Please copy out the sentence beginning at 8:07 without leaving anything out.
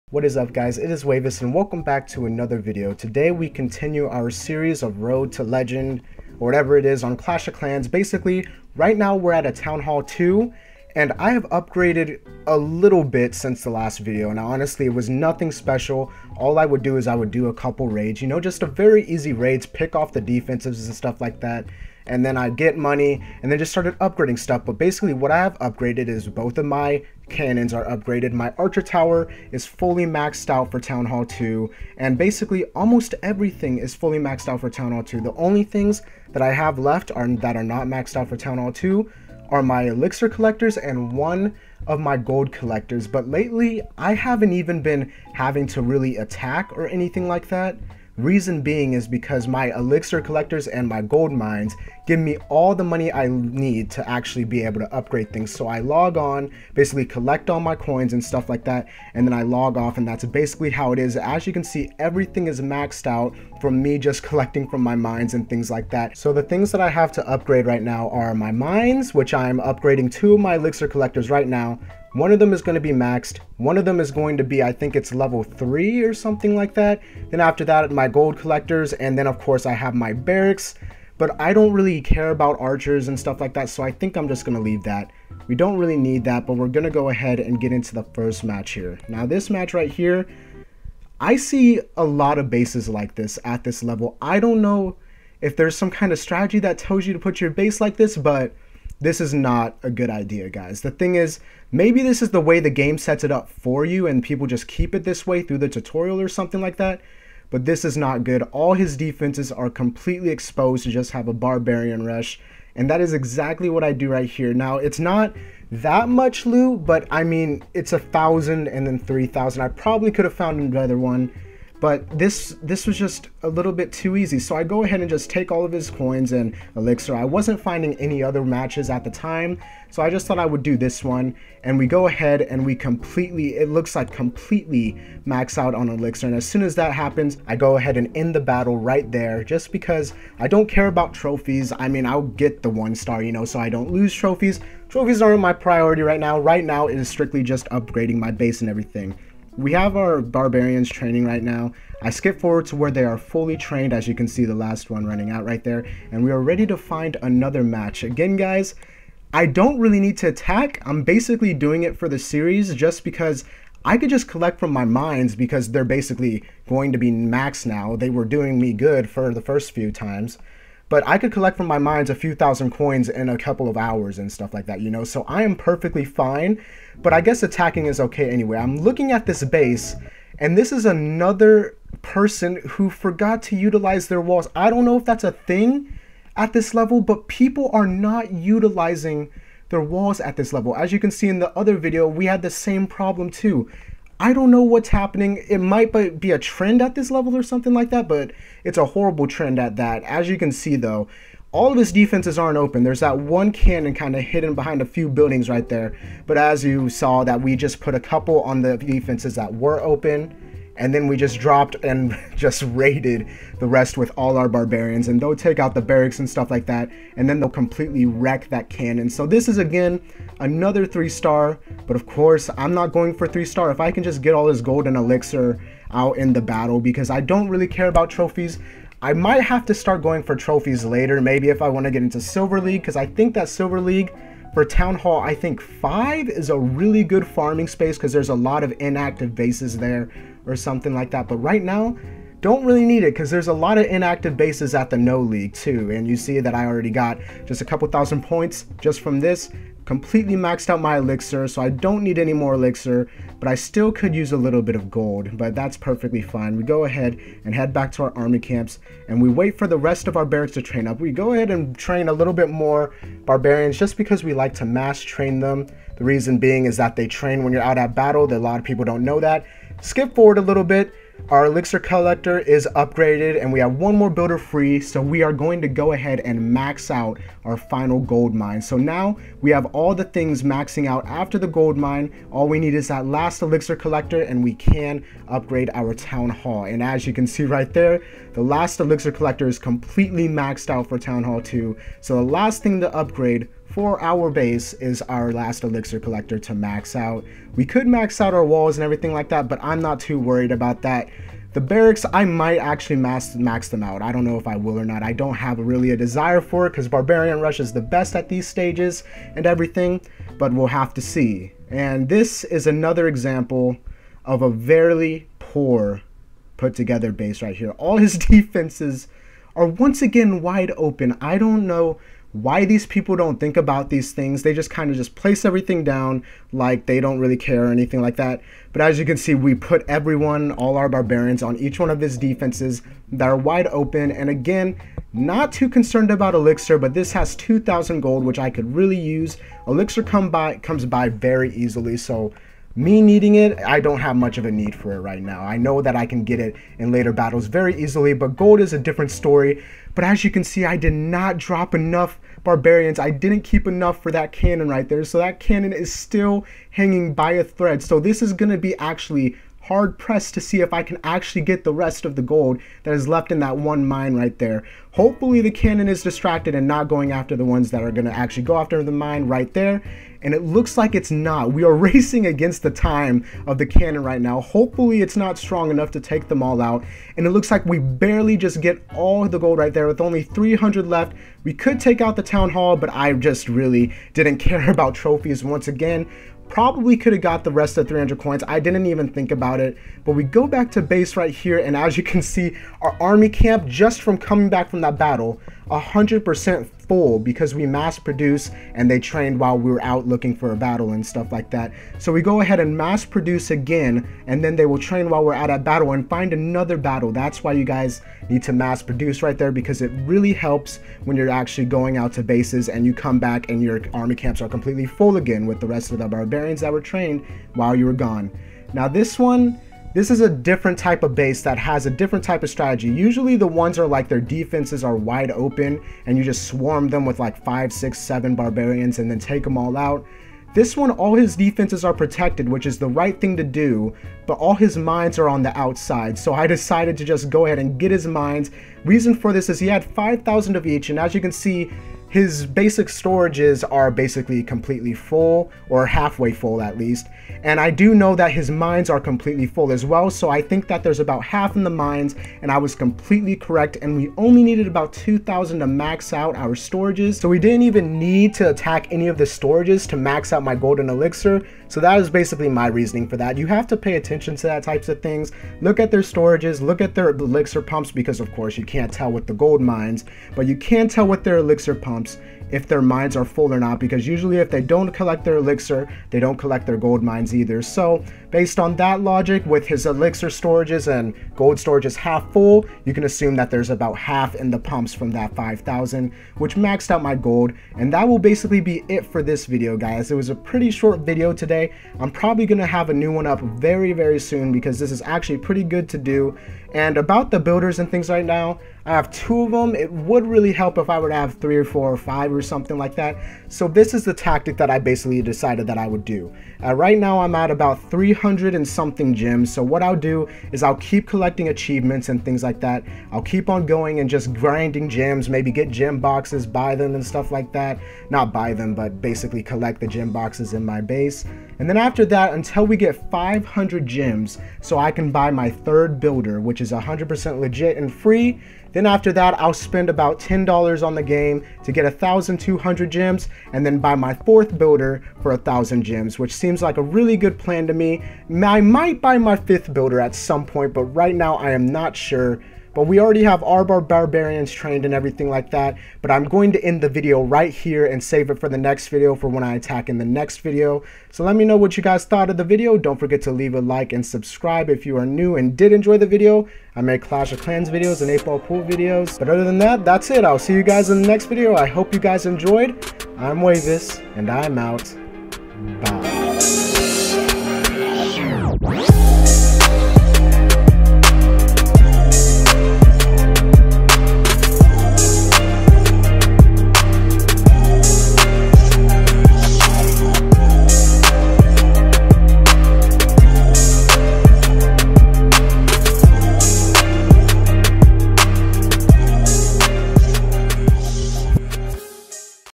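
And that will basically be it for this video, guys.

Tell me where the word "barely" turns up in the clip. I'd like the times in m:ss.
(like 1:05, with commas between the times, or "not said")
6:17.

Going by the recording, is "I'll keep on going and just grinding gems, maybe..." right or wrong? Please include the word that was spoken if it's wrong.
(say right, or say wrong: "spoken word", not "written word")
right.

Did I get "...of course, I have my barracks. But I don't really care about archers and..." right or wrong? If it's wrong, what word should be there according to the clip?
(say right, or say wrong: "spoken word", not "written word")
right.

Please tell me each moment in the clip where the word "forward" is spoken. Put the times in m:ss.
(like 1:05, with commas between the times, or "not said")
2:32, 4:30.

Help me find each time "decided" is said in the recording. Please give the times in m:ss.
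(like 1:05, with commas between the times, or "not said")
7:16, 8:25.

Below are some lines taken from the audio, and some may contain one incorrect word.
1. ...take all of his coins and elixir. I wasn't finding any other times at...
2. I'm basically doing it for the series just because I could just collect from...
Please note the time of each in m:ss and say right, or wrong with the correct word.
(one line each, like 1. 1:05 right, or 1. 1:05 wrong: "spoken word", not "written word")
1. 2:05 wrong: "matches", not "times"
2. 2:40 right.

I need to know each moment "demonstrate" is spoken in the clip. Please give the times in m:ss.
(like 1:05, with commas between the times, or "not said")
not said.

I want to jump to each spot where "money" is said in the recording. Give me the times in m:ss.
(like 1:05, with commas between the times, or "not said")
0:22, 0:52.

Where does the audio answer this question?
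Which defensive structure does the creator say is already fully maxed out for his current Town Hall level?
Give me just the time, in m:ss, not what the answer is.
0:28.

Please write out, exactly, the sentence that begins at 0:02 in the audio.
Today we continue our series of Road to Legend, or whatever it is, on Clash of Clans.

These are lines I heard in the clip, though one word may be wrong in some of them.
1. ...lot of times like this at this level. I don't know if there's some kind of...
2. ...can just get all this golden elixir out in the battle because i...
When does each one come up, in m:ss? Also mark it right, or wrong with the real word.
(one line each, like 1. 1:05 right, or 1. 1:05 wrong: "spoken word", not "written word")
1. 1:32 wrong: "bases", not "times"
2. 3:43 right.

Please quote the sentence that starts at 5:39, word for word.
Elixir come by comes by very easily, so me needing it, I don't have much of a need for it right now.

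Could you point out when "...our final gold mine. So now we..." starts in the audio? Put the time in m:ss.
4:37.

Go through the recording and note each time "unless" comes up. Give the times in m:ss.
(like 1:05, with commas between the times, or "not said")
not said.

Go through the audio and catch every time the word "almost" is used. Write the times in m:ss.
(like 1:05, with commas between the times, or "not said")
0:32.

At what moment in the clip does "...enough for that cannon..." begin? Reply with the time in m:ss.
5:53.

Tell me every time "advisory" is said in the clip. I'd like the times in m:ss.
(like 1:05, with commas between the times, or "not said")
not said.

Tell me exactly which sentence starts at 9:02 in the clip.
But we already have our Barbarians trained and everything like that.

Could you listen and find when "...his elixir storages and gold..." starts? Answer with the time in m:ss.
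7:59.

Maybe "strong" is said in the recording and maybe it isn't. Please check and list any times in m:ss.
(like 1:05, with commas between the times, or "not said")
6:15.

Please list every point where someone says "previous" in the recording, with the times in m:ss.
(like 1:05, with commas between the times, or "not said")
not said.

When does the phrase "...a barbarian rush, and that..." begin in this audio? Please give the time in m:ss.
1:51.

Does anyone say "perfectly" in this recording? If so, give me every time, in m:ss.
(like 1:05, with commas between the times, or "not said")
2:55, 4:15.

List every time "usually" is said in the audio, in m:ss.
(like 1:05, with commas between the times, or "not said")
7:02, 7:54.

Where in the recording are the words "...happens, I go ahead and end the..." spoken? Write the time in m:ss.
2:16.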